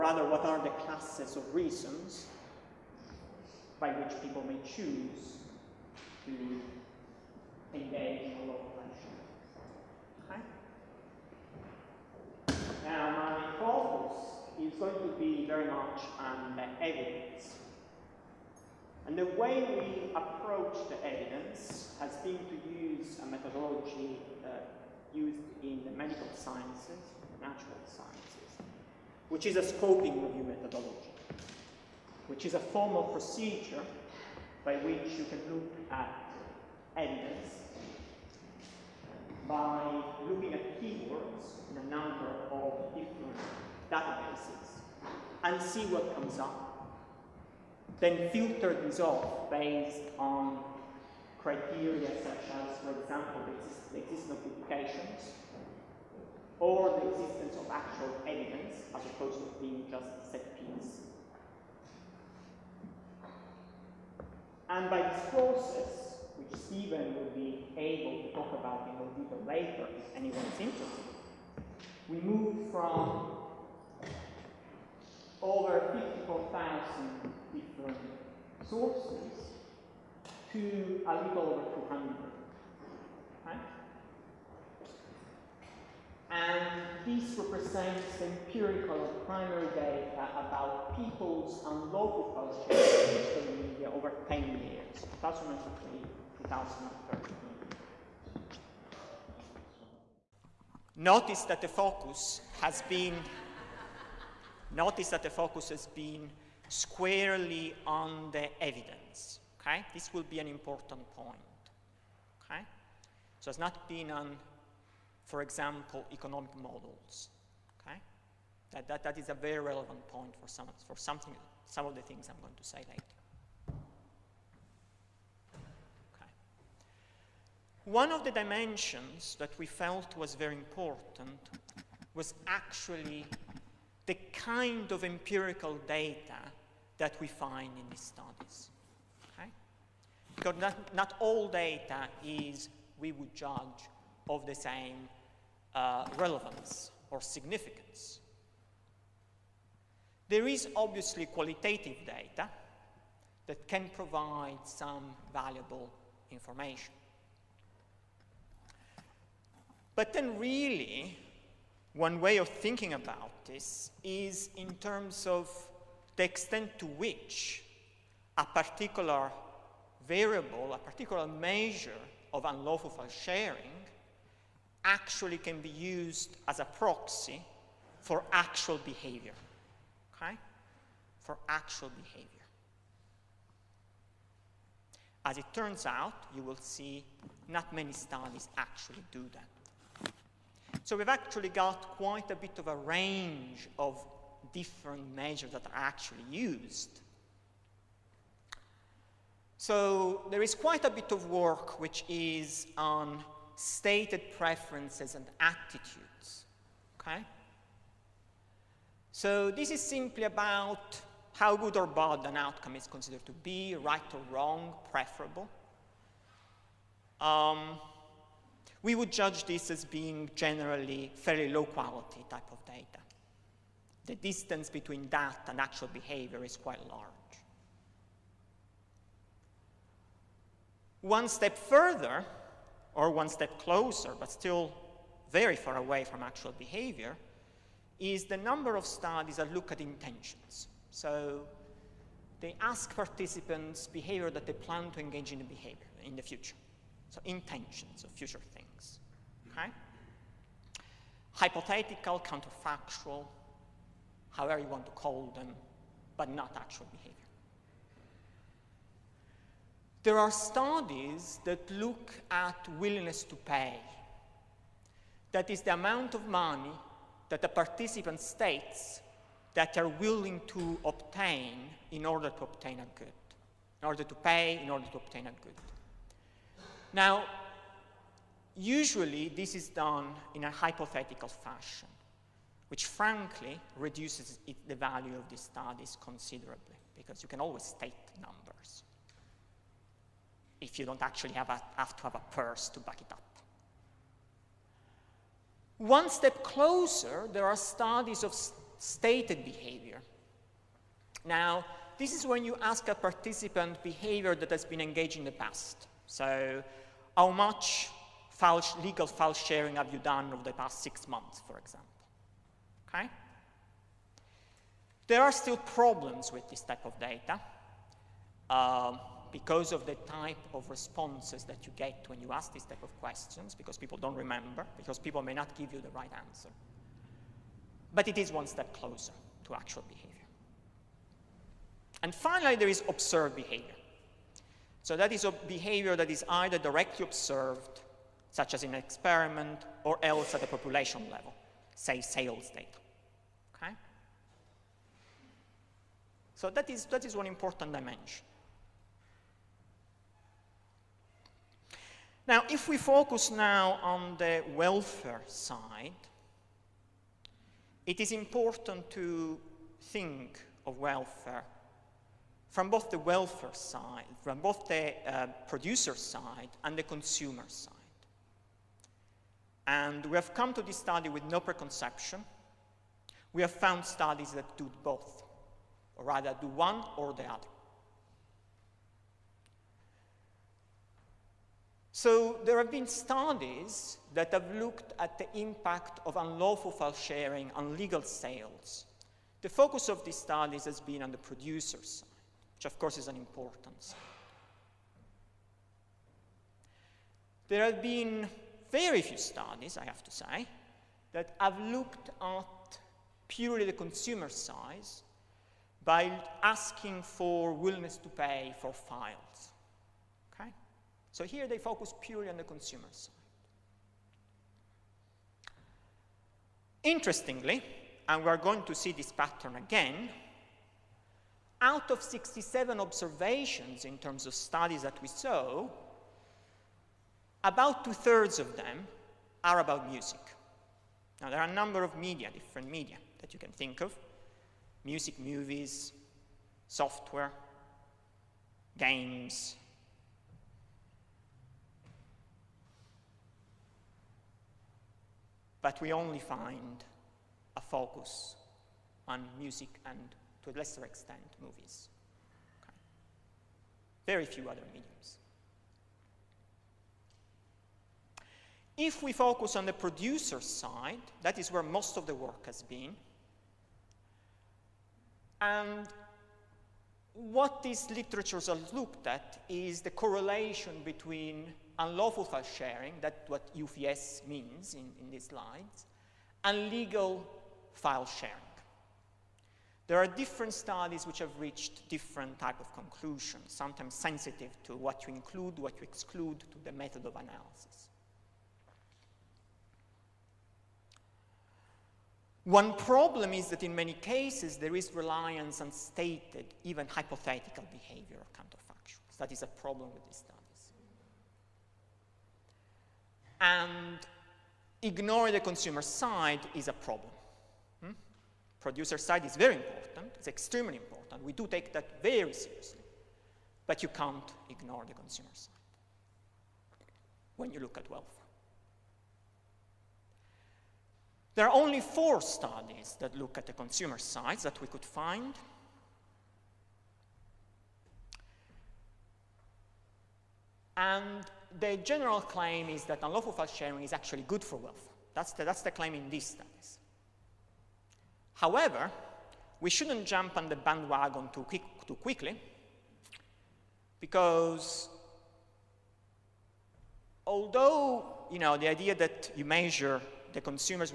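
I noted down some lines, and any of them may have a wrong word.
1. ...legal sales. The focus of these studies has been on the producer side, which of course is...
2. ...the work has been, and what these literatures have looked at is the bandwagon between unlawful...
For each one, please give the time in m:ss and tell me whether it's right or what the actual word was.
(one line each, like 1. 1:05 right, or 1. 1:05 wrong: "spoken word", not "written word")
1. 6:27 right
2. 7:42 wrong: "correlation", not "bandwagon".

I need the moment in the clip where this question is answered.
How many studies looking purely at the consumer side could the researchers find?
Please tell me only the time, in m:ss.
8:41.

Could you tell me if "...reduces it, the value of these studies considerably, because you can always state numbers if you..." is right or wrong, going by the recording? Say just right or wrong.
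right.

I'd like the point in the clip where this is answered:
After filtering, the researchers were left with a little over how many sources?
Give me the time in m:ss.
1:21.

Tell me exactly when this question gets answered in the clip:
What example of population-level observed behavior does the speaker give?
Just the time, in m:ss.
5:42.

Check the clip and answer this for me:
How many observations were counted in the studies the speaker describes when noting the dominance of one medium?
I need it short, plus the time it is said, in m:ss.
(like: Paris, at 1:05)
67, at 7:02.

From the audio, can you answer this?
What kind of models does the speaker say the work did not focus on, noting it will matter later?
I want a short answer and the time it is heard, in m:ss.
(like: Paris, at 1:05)
economic models, at 1:56.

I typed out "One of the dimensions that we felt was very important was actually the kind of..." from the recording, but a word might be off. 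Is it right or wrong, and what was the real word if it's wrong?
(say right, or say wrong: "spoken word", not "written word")
right.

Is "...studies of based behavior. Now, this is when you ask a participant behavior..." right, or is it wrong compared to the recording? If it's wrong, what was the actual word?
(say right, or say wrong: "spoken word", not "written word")
wrong: "stated", not "based".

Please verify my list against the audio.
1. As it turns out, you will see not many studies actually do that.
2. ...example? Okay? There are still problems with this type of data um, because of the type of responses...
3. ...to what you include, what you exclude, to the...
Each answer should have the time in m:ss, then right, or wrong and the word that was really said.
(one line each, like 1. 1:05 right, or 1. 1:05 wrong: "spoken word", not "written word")
1. 3:05 right
2. 5:11 right
3. 8:04 right.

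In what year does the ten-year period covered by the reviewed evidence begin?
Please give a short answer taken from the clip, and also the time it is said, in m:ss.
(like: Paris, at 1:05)
2003, at 1:35.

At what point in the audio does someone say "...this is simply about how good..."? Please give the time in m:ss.
3:29.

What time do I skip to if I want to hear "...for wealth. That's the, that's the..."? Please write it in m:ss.
8:54.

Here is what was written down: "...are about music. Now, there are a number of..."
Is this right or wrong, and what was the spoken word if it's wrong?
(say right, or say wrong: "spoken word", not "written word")
right.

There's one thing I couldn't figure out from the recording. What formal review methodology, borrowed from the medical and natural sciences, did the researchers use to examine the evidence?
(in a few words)
scoping review.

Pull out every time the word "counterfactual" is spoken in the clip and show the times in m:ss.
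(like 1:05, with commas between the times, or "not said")
4:12, 8:18.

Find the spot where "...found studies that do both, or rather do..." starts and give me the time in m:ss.
6:13.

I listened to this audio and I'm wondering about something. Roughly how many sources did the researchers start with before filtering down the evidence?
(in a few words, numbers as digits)
54,000.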